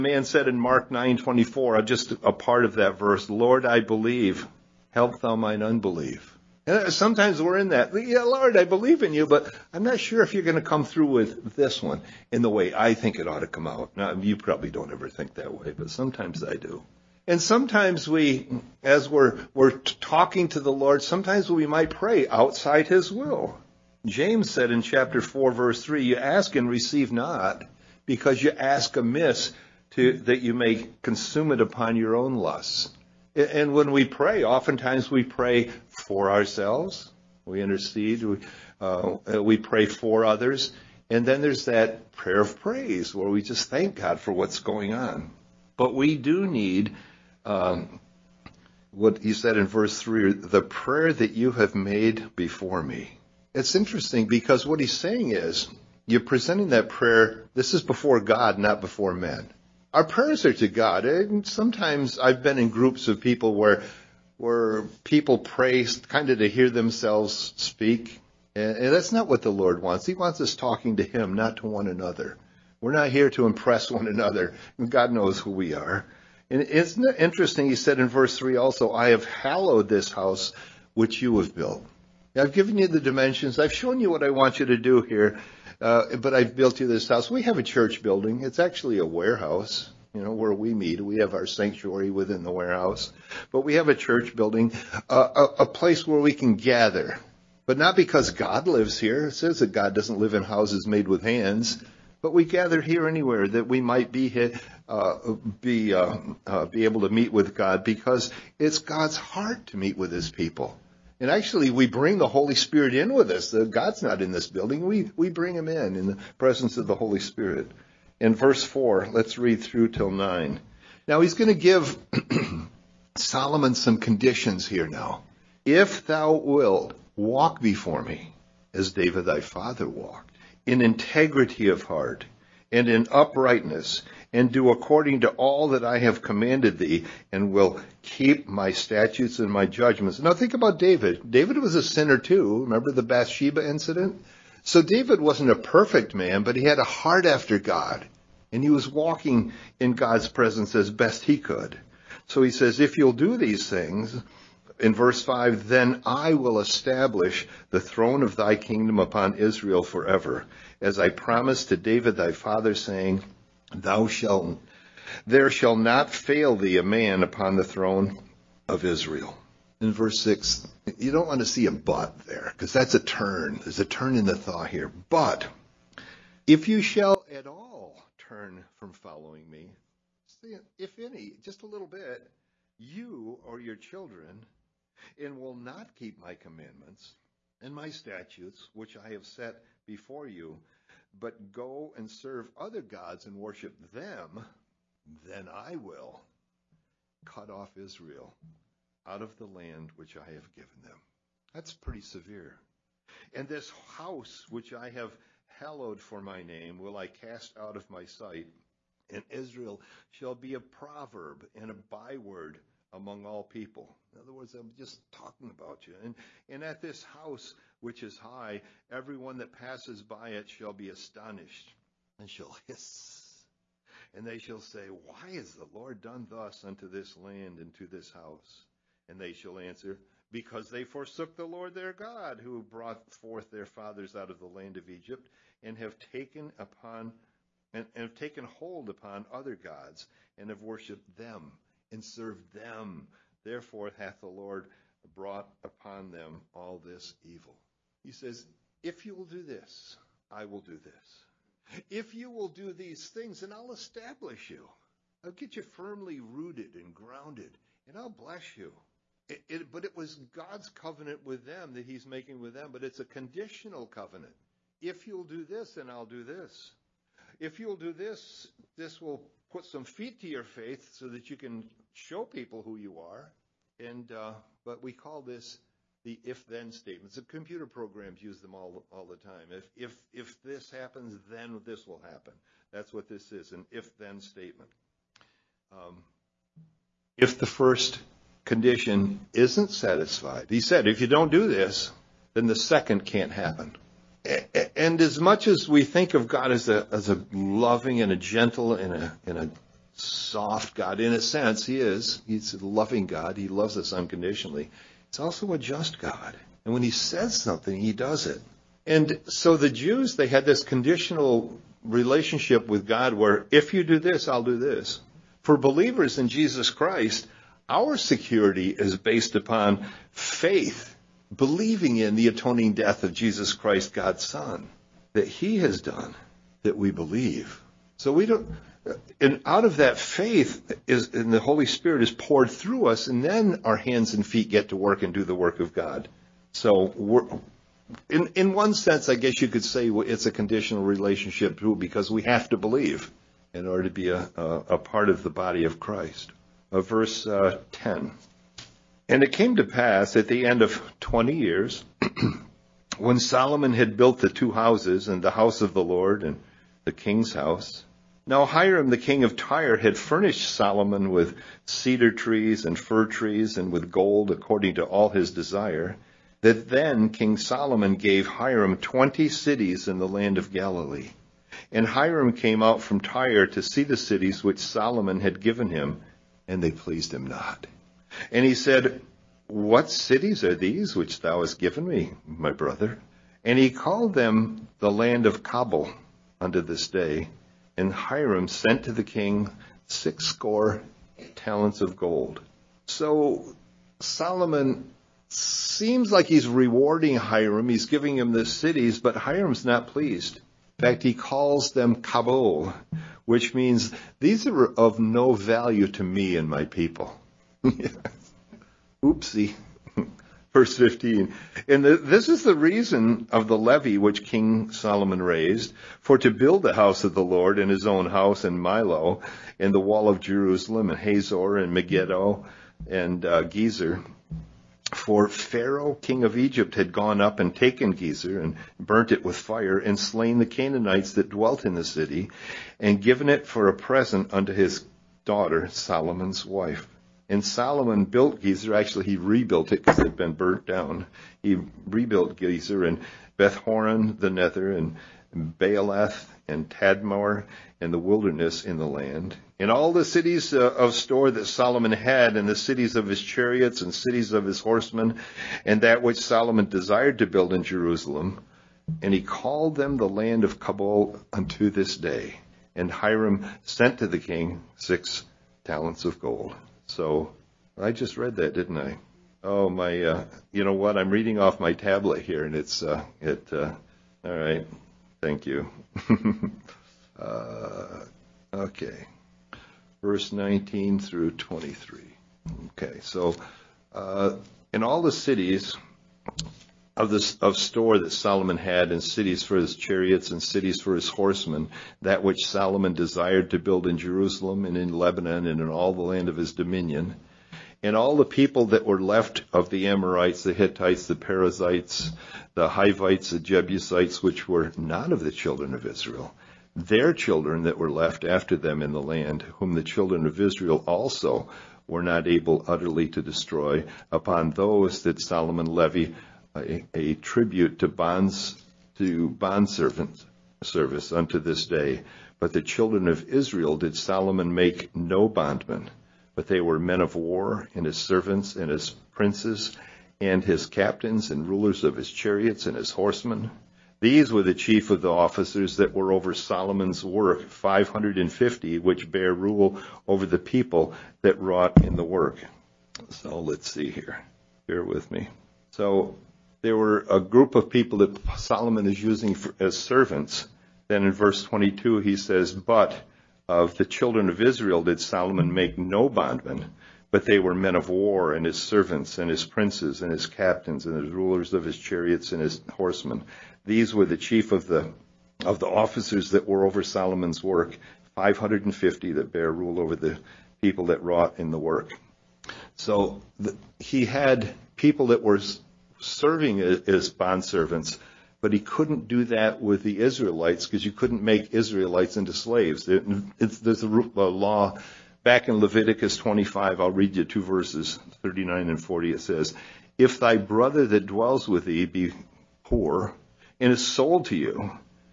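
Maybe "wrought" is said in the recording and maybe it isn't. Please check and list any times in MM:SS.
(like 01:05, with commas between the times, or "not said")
09:01, 09:31.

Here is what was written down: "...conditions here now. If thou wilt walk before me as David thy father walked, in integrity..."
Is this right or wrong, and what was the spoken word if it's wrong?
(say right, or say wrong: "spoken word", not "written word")
right.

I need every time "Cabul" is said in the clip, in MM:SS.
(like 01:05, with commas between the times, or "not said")
06:25, 06:42, 07:40.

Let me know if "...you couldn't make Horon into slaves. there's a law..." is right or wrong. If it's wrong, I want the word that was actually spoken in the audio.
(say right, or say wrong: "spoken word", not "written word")
wrong: "Israelites", not "Horon".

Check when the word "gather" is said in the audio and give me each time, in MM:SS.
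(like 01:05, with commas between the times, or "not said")
01:36, 01:42.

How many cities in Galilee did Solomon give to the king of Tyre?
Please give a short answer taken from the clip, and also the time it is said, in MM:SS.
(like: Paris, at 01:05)
20, at 06:08.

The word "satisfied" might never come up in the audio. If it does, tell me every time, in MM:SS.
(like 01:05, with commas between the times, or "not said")
04:49.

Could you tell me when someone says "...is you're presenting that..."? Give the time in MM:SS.
00:55.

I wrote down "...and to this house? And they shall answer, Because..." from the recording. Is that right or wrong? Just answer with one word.
right.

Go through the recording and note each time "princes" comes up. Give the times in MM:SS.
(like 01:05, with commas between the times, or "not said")
08:49, 09:19.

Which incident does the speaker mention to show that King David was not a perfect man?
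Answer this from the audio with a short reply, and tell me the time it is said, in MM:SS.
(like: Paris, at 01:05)
Bathsheba incident, at 02:23.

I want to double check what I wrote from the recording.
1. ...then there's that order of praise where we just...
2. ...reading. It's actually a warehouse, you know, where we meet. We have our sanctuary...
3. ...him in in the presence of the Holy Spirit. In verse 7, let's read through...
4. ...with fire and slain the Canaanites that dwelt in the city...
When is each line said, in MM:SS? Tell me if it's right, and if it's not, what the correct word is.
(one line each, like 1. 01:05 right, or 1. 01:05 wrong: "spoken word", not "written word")
1. 00:41 wrong: "prayer", not "order"
2. 01:28 wrong: "building", not "reading"
3. 01:55 wrong: "4", not "7"
4. 07:09 right.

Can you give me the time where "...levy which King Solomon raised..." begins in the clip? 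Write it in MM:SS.
06:53.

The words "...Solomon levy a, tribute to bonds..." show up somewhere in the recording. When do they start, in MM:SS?
08:35.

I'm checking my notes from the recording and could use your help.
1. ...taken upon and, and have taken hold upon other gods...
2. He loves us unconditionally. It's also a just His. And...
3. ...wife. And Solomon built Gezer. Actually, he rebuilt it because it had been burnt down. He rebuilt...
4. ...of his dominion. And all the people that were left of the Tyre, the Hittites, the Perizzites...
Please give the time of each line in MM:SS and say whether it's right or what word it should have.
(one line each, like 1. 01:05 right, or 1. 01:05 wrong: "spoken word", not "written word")
1. 03:55 right
2. 05:03 wrong: "God", not "His"
3. 07:16 right
4. 08:16 wrong: "Amorites", not "Tyre".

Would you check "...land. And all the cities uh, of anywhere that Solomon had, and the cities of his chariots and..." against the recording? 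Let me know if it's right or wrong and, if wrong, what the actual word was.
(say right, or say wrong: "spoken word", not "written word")
wrong: "store", not "anywhere".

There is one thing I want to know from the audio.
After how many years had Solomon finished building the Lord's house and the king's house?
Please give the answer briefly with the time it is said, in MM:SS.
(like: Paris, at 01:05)
20, at 05:50.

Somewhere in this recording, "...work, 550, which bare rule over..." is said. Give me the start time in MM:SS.
08:57.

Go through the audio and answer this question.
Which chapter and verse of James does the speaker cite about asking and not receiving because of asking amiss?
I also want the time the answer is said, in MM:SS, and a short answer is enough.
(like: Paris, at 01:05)
chapter 4, verse 3, at 00:24.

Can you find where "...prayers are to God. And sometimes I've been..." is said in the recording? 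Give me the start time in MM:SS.
01:00.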